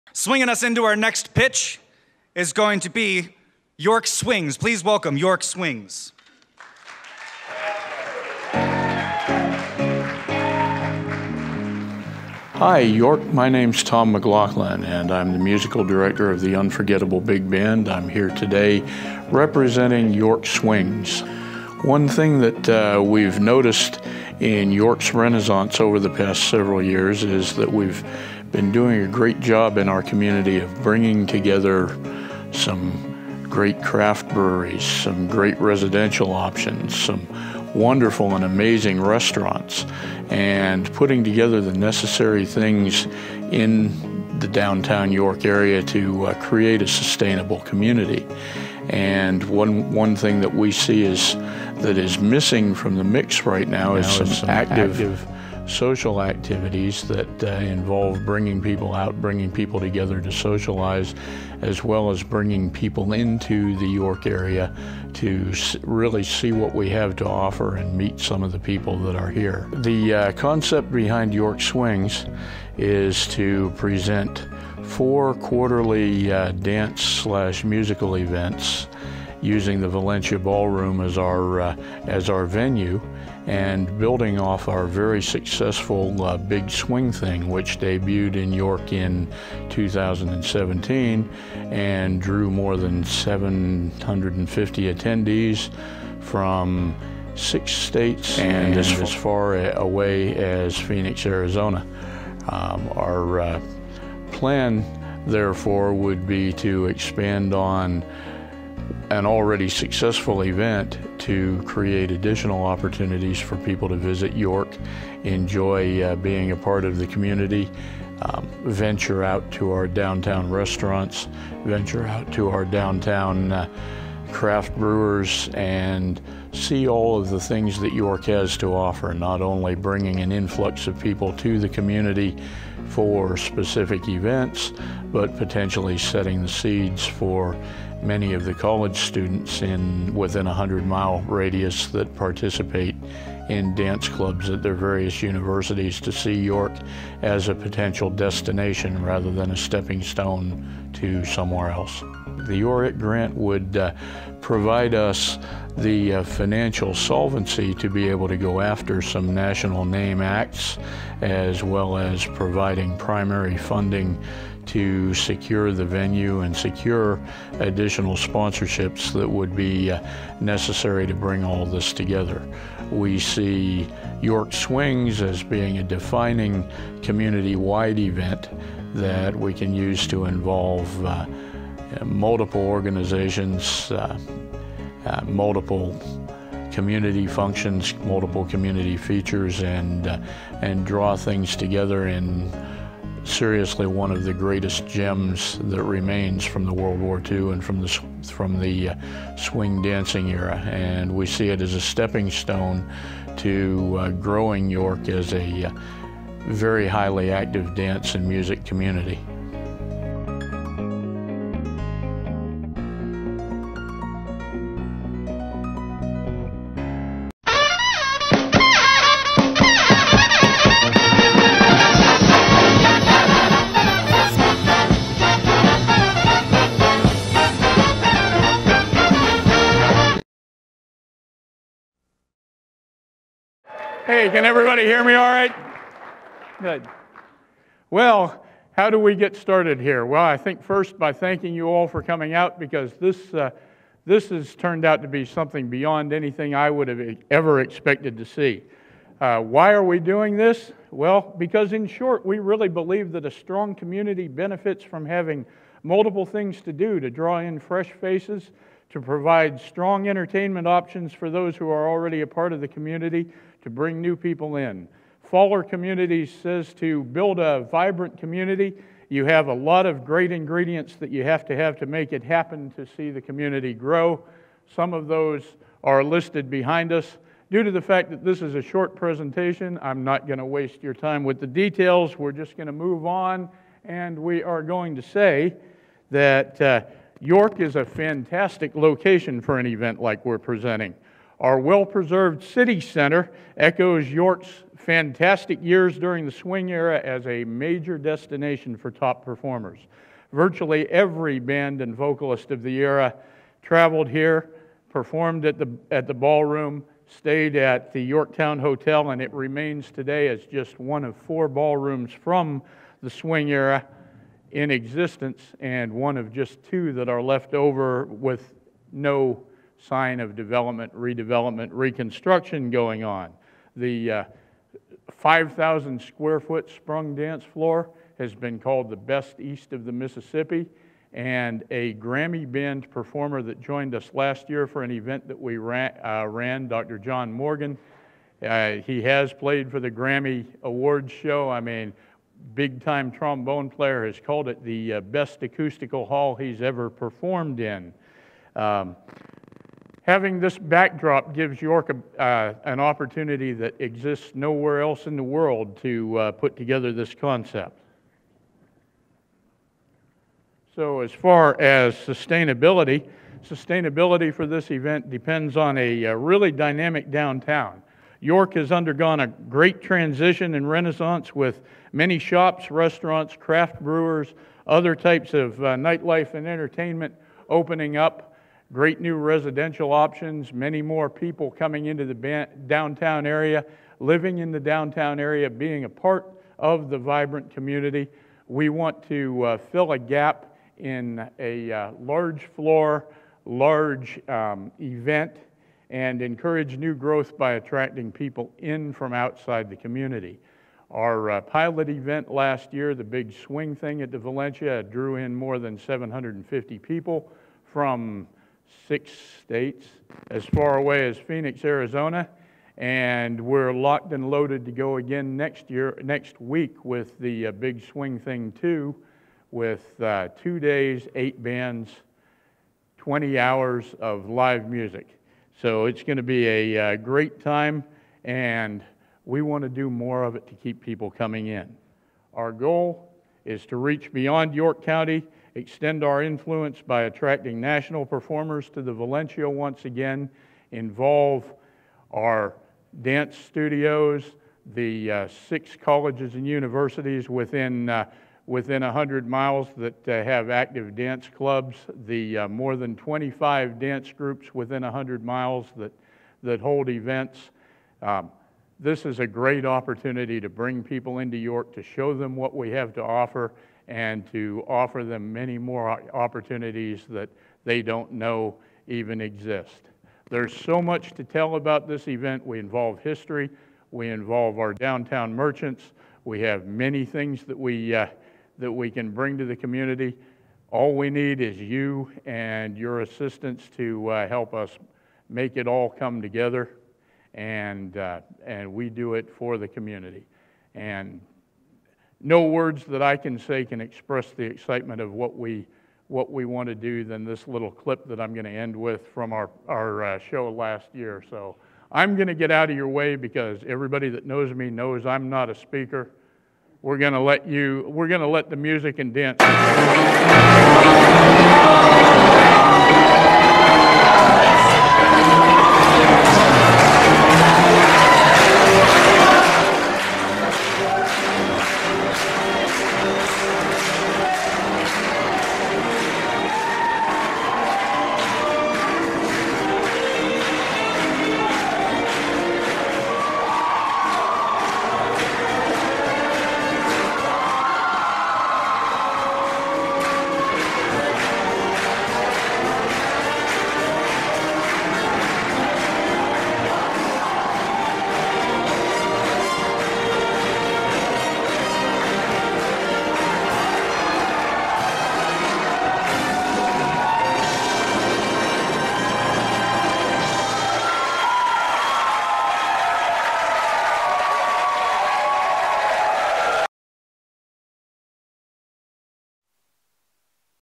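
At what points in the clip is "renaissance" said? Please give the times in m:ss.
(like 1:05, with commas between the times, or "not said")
0:25, 6:10.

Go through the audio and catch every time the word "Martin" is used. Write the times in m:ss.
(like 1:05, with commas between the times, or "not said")
not said.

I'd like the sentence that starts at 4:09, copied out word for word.
Uh, why are we doing this?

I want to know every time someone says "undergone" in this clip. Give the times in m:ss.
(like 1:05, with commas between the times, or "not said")
6:08.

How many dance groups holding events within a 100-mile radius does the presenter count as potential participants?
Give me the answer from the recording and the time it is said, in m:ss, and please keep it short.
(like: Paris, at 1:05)
more than 25, at 7:32.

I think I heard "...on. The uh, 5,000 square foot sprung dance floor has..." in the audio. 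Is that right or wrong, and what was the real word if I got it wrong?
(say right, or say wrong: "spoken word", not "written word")
right.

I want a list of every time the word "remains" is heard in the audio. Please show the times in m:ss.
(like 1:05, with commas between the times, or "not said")
3:15, 5:09.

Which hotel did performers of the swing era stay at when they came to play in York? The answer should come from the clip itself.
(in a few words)
Yorktown Hotel.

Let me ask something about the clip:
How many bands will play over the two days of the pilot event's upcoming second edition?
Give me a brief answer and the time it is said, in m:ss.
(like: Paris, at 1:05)
8, at 7:01.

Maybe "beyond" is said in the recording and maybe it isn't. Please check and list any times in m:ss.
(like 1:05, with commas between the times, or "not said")
4:05, 7:14.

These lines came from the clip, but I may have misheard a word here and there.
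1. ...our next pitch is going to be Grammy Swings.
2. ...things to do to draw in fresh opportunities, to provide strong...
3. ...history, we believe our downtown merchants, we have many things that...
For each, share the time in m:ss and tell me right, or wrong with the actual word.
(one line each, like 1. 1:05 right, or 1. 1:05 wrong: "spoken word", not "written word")
1. 0:00 wrong: "York", not "Grammy"
2. 4:16 wrong: "faces", not "opportunities"
3. 7:52 wrong: "involve", not "believe".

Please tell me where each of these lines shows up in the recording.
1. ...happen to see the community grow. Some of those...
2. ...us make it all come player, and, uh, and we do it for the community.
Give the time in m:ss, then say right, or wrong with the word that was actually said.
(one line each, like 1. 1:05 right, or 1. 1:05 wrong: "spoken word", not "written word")
1. 4:32 right
2. 8:04 wrong: "together", not "player".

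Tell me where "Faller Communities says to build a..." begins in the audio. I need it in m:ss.
4:25.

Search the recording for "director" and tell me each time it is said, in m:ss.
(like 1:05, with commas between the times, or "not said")
0:15.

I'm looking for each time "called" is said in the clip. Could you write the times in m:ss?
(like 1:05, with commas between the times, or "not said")
5:28, 5:44.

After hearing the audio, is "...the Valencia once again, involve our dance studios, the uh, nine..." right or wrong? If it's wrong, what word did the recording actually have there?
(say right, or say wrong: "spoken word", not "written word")
wrong: "six", not "nine".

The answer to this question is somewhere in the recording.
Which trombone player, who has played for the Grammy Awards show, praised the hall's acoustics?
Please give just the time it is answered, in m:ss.
5:36.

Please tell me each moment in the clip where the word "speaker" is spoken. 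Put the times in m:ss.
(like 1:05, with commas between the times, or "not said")
8:25.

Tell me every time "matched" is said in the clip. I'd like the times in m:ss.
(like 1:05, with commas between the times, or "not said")
not said.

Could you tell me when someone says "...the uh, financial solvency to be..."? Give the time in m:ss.
2:35.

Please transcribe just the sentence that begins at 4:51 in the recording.
Our well preserved city center echoes York's fantastic years during the swing era as a major destination for top performers.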